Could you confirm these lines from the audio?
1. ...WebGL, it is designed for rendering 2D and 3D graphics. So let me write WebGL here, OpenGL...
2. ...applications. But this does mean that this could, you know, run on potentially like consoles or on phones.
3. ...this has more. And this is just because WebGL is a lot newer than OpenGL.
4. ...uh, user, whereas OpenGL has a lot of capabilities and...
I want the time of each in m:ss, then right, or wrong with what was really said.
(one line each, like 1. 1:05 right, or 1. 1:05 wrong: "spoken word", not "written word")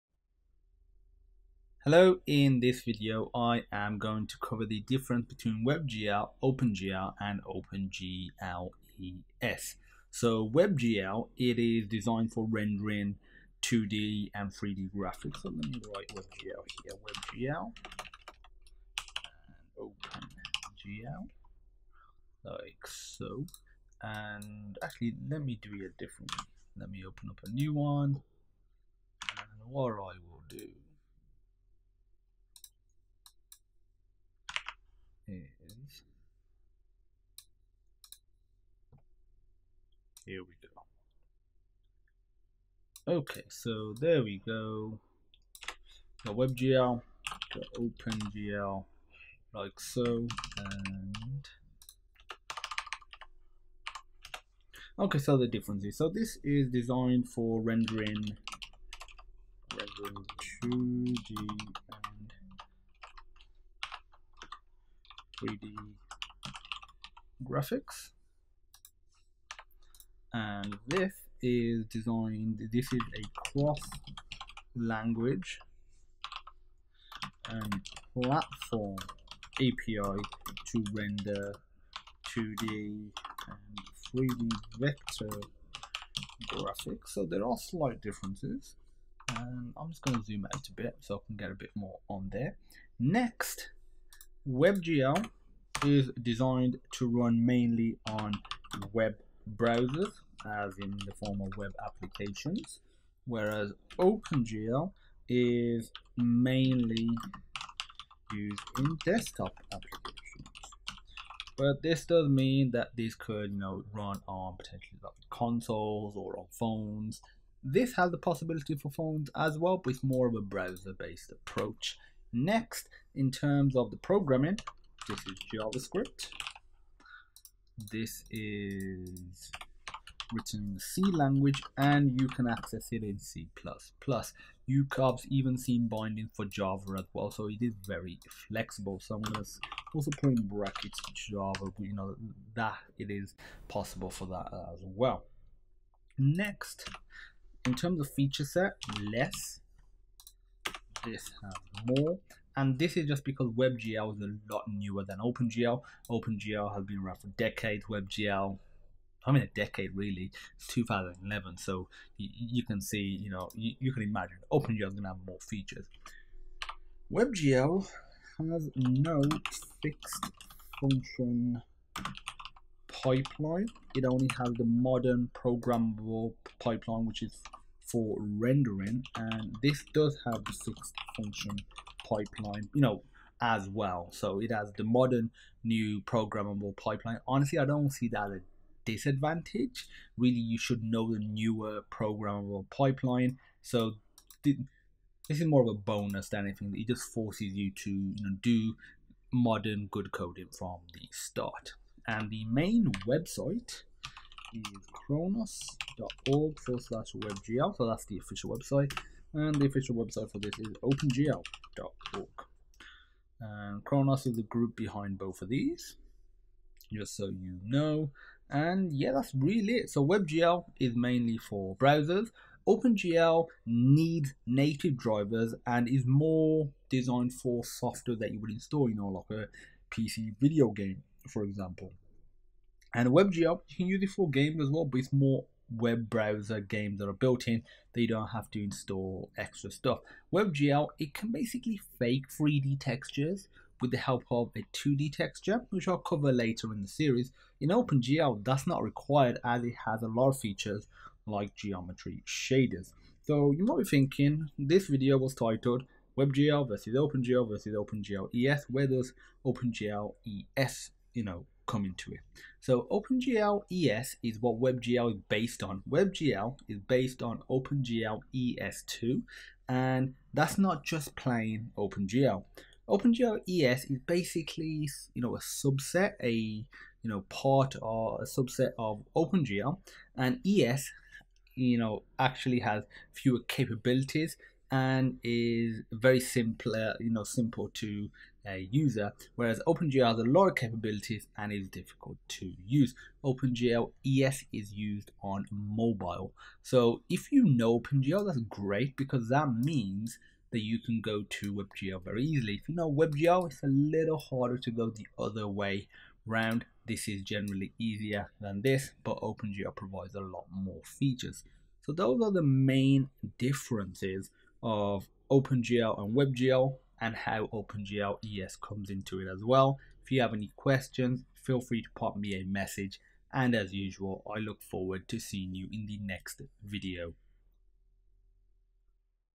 1. 0:10 wrong: "WebGL", not "OpenGL"
2. 1:49 right
3. 2:31 right
4. 4:48 right.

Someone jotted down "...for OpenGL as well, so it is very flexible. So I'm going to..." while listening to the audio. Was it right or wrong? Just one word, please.
wrong.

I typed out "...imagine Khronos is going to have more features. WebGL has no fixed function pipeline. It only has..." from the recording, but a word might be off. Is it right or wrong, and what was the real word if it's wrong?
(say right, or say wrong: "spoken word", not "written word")
wrong: "OpenGL", not "Khronos".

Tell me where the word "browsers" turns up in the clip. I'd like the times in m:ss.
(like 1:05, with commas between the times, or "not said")
1:39, 2:00, 3:41, 3:56.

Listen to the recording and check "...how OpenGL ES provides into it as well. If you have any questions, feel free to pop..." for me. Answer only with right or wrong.
wrong.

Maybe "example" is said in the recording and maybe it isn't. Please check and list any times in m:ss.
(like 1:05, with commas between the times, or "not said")
3:51.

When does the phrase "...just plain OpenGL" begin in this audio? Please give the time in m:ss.
4:30.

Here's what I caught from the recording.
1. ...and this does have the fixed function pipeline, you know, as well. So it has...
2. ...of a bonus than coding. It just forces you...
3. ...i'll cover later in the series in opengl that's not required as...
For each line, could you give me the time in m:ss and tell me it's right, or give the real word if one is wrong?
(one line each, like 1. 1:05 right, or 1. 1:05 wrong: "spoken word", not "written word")
1. 2:59 right
2. 3:15 wrong: "anything", not "coding"
3. 4:05 right.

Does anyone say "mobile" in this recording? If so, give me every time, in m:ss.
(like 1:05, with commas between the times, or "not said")
4:55.